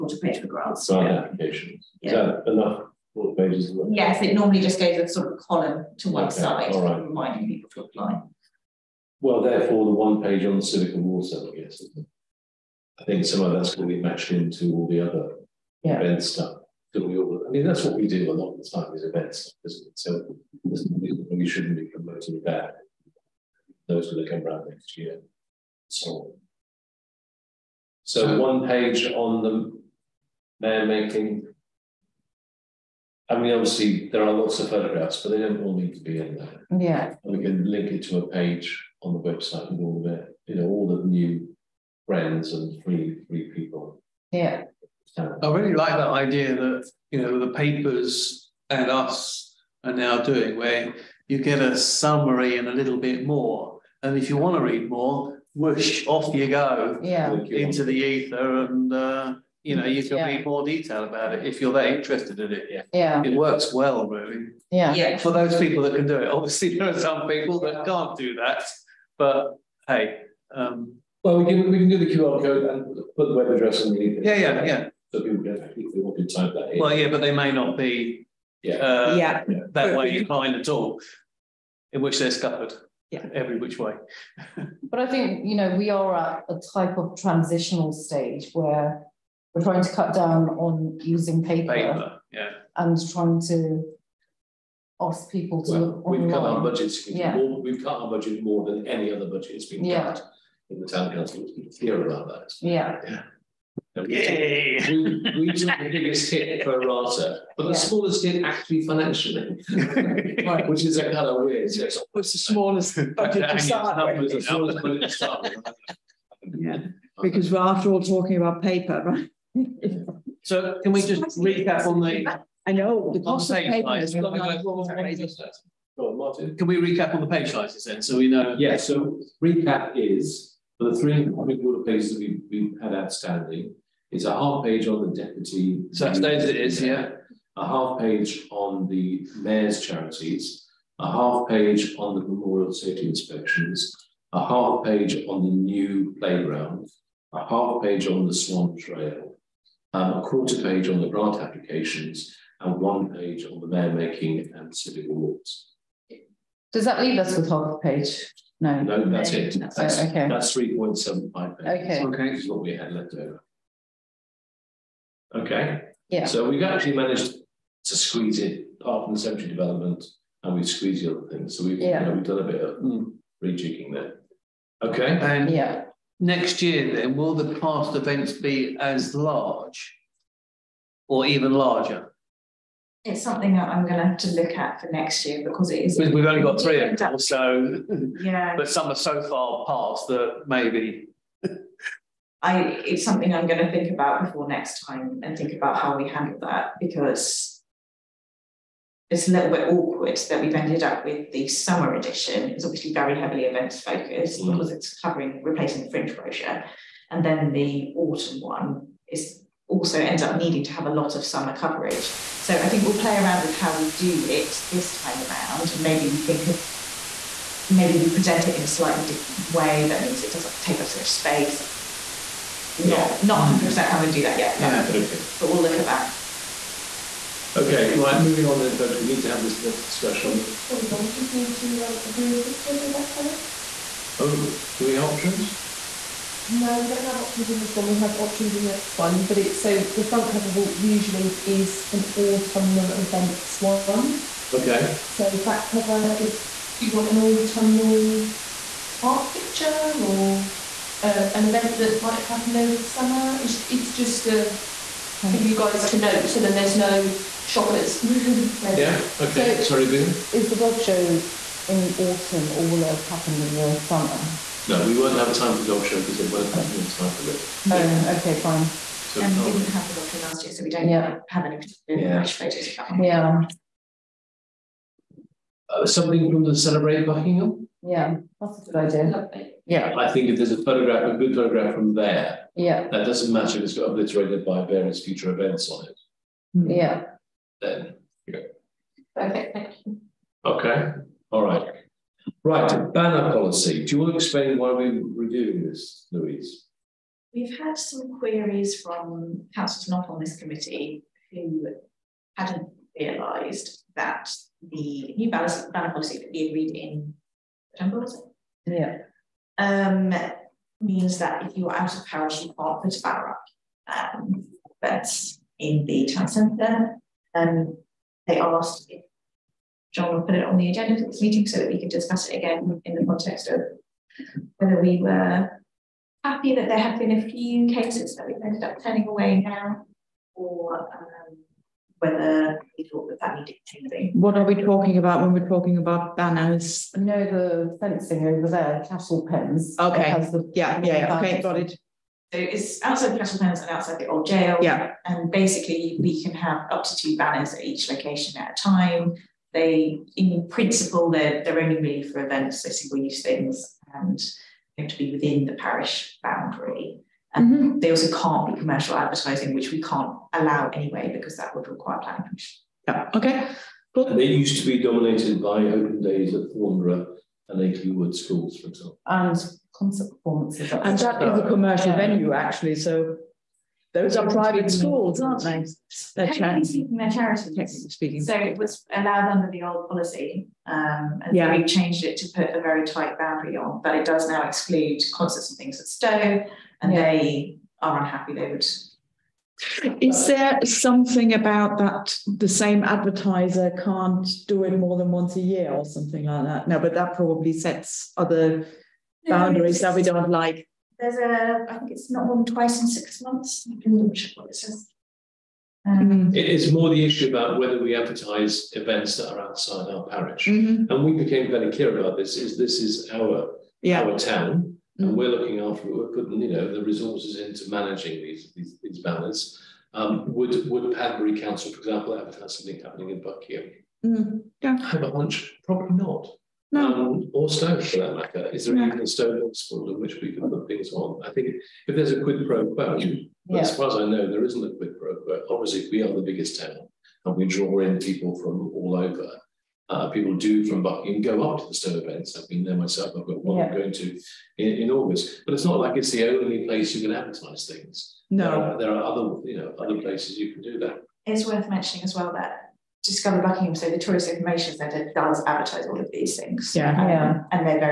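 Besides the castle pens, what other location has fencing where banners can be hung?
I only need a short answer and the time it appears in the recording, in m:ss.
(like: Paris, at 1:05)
the old jail, at 5:43.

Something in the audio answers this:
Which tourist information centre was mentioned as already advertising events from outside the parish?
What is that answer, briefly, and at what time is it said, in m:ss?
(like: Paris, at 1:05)
Discover Buckingham, at 7:33.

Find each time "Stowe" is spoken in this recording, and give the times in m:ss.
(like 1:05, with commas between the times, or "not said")
6:25, 7:21.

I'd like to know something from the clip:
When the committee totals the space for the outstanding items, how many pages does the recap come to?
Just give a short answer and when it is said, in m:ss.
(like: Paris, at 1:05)
3.75, at 2:40.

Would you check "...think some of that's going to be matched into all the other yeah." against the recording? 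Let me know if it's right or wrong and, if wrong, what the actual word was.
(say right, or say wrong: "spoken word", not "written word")
right.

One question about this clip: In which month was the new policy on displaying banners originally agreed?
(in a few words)
September.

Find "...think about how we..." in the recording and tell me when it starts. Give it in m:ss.
3:15.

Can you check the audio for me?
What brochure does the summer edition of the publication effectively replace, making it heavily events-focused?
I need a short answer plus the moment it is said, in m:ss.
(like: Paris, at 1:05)
fringe brochure, at 3:25.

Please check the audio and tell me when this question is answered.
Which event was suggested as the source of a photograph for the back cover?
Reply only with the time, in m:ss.
4:36.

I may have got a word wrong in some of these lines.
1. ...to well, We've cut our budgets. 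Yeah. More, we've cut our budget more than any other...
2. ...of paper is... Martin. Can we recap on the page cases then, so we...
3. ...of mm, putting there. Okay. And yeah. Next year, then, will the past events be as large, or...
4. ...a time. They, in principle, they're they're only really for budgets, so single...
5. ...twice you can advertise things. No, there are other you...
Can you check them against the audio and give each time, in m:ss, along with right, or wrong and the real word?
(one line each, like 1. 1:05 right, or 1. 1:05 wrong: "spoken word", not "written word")
1. 1:35 right
2. 2:03 wrong: "sizes", not "cases"
3. 2:52 wrong: "rejigging", not "putting"
4. 5:48 wrong: "events", not "budgets"
5. 7:26 wrong: "place", not "twice".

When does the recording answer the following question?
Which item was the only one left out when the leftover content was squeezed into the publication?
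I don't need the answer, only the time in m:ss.
2:49.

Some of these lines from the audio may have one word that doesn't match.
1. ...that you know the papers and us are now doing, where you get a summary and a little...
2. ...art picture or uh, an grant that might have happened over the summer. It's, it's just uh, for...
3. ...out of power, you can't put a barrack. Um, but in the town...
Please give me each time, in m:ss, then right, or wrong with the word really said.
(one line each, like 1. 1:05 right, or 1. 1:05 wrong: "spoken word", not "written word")
1. 0:46 right
2. 4:09 wrong: "event", not "grant"
3. 5:11 right.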